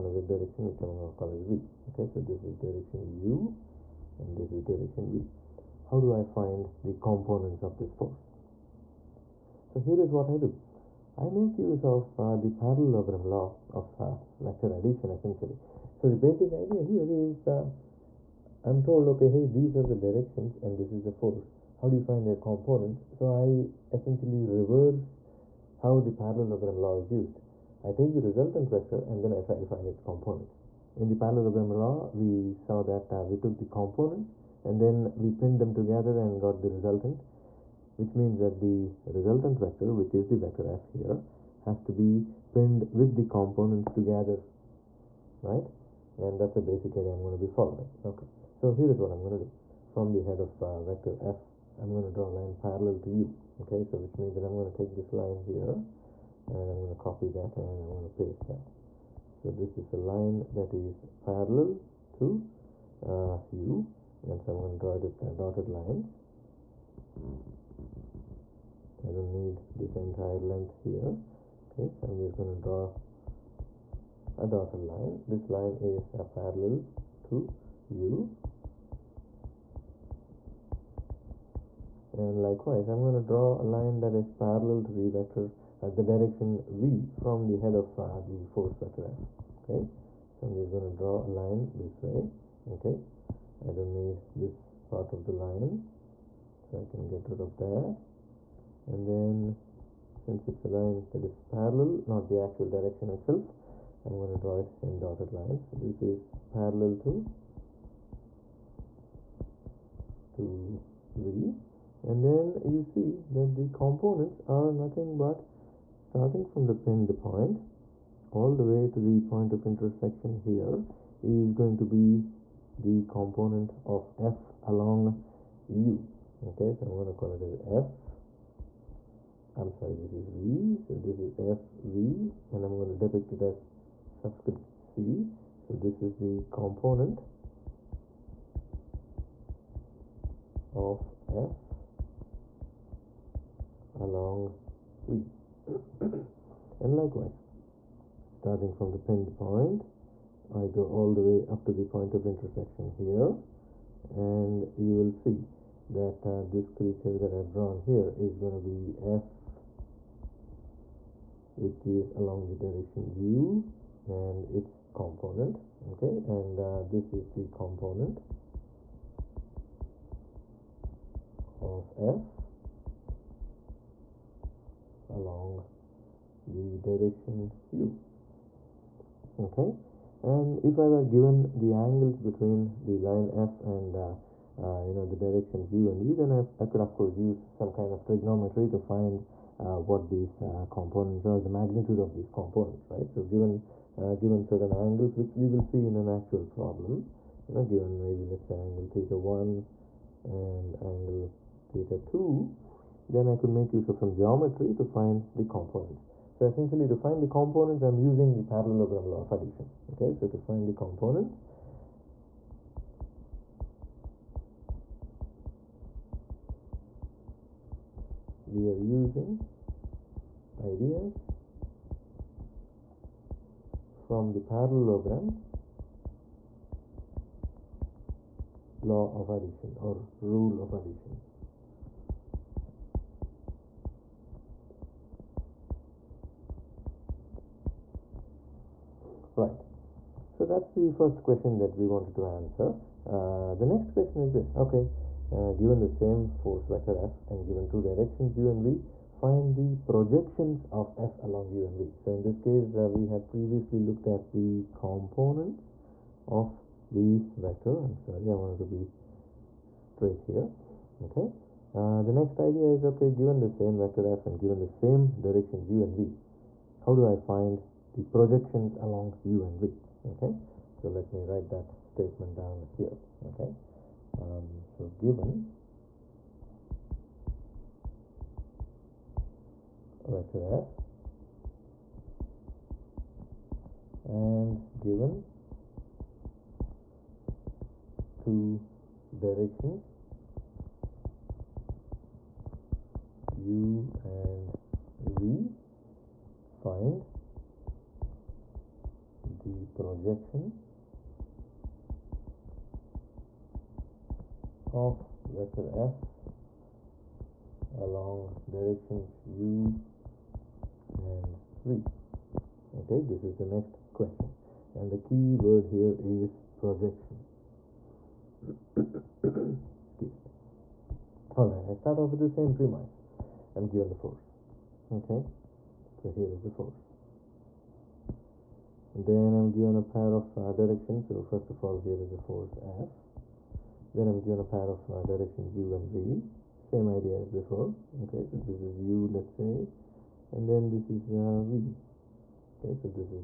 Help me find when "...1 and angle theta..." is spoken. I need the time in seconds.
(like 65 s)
199 s.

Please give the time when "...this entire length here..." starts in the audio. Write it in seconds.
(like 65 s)
69 s.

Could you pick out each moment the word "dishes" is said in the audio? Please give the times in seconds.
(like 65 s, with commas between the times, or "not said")
not said.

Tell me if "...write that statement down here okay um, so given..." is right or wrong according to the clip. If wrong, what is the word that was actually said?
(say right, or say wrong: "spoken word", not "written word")
right.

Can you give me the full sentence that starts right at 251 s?
So in this case, uh, we had previously looked at the components of the vector.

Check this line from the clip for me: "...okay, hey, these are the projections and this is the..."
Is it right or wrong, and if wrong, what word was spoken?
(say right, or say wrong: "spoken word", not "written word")
wrong: "directions", not "projections".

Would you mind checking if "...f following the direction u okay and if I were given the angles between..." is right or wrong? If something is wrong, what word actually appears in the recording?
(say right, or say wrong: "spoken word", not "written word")
wrong: "along", not "following".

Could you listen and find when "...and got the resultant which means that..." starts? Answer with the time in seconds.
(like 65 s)
36 s.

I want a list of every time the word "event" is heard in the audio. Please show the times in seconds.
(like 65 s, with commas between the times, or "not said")
not said.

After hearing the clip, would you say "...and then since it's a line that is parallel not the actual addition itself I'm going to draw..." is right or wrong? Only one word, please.
wrong.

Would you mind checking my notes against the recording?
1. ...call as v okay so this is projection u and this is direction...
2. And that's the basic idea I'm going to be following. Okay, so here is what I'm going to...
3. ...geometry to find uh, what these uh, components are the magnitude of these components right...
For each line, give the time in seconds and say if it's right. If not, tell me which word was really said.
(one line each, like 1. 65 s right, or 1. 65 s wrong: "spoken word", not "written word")
1. 1 s wrong: "direction", not "projection"
2. 46 s right
3. 188 s wrong: "trigonometry", not "geometry".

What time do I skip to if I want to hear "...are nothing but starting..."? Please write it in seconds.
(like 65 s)
114 s.